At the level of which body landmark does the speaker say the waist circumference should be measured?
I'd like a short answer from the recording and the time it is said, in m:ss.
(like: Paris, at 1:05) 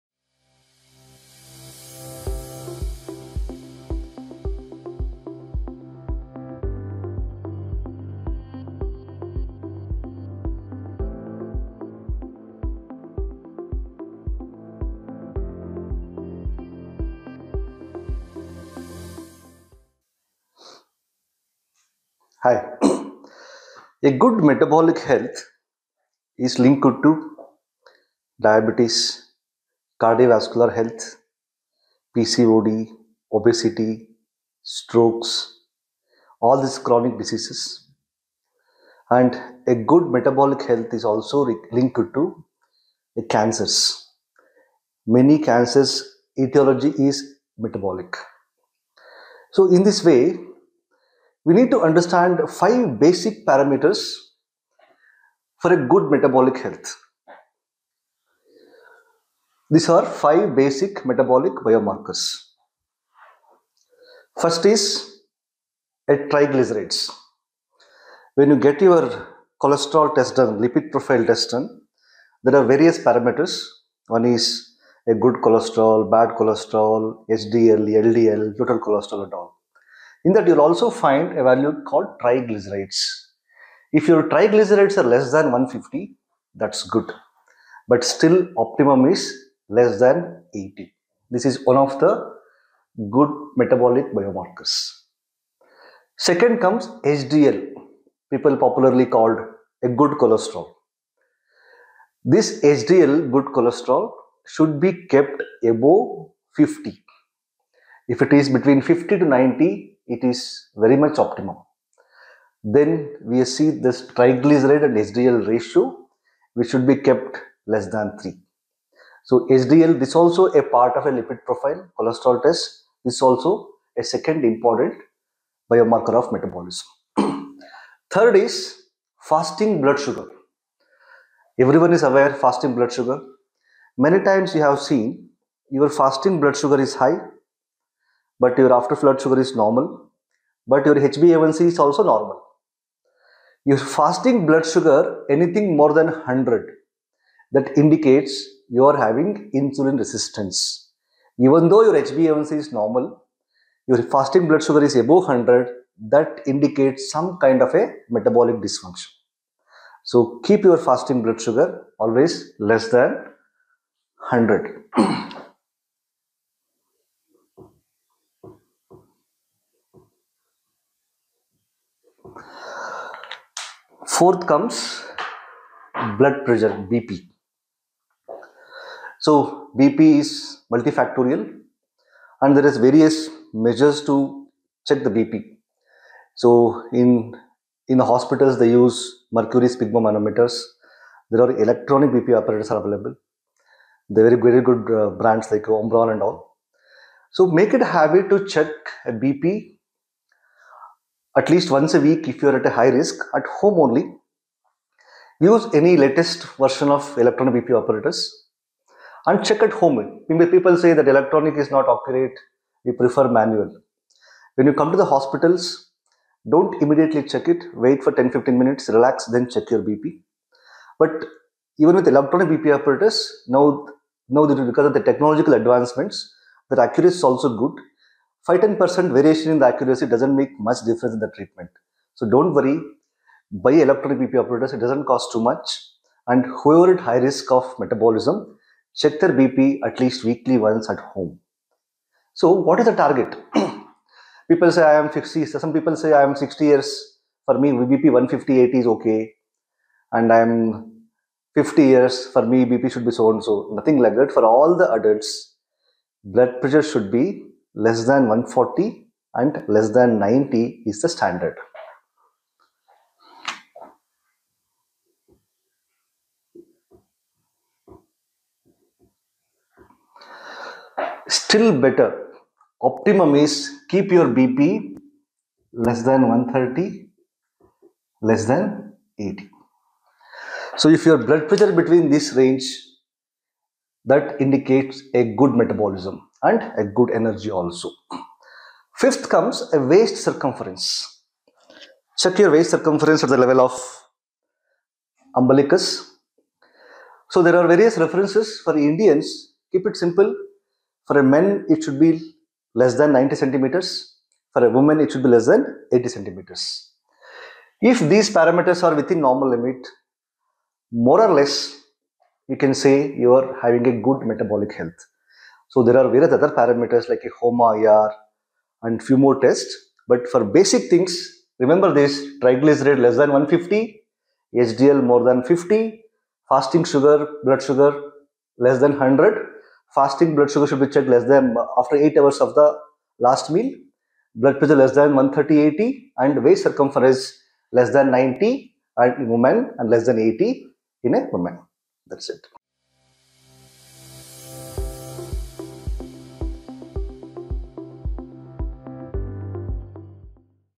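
Umbilicus, at 4:55.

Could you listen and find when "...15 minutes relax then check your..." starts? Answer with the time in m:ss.
3:38.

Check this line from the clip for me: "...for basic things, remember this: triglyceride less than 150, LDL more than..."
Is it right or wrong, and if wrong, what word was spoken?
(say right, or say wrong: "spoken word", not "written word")
wrong: "HDL", not "LDL".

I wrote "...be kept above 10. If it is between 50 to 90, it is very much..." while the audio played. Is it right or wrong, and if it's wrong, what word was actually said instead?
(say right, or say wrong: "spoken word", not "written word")
wrong: "50", not "10".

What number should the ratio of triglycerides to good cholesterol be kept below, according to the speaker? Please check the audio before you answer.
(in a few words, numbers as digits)
3.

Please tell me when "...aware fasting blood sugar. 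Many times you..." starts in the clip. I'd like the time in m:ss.
2:12.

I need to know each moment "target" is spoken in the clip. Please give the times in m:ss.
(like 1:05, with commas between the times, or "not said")
4:02.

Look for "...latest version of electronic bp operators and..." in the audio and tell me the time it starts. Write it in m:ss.
3:26.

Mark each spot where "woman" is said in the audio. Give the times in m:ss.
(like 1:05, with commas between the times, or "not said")
5:04, 5:41.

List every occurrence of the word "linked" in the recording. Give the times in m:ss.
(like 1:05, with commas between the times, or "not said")
0:26, 0:41.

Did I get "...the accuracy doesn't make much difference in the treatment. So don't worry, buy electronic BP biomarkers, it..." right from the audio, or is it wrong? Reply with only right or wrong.
wrong.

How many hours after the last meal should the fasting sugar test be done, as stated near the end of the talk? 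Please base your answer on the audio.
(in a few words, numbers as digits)
8 hours.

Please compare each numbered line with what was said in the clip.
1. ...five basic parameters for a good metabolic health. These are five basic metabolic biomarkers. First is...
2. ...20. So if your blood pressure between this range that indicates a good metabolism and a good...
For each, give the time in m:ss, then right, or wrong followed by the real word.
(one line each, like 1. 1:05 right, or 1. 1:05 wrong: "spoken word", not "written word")
1. 0:52 right
2. 4:39 wrong: "80", not "20".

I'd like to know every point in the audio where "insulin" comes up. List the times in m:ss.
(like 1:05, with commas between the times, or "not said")
2:29.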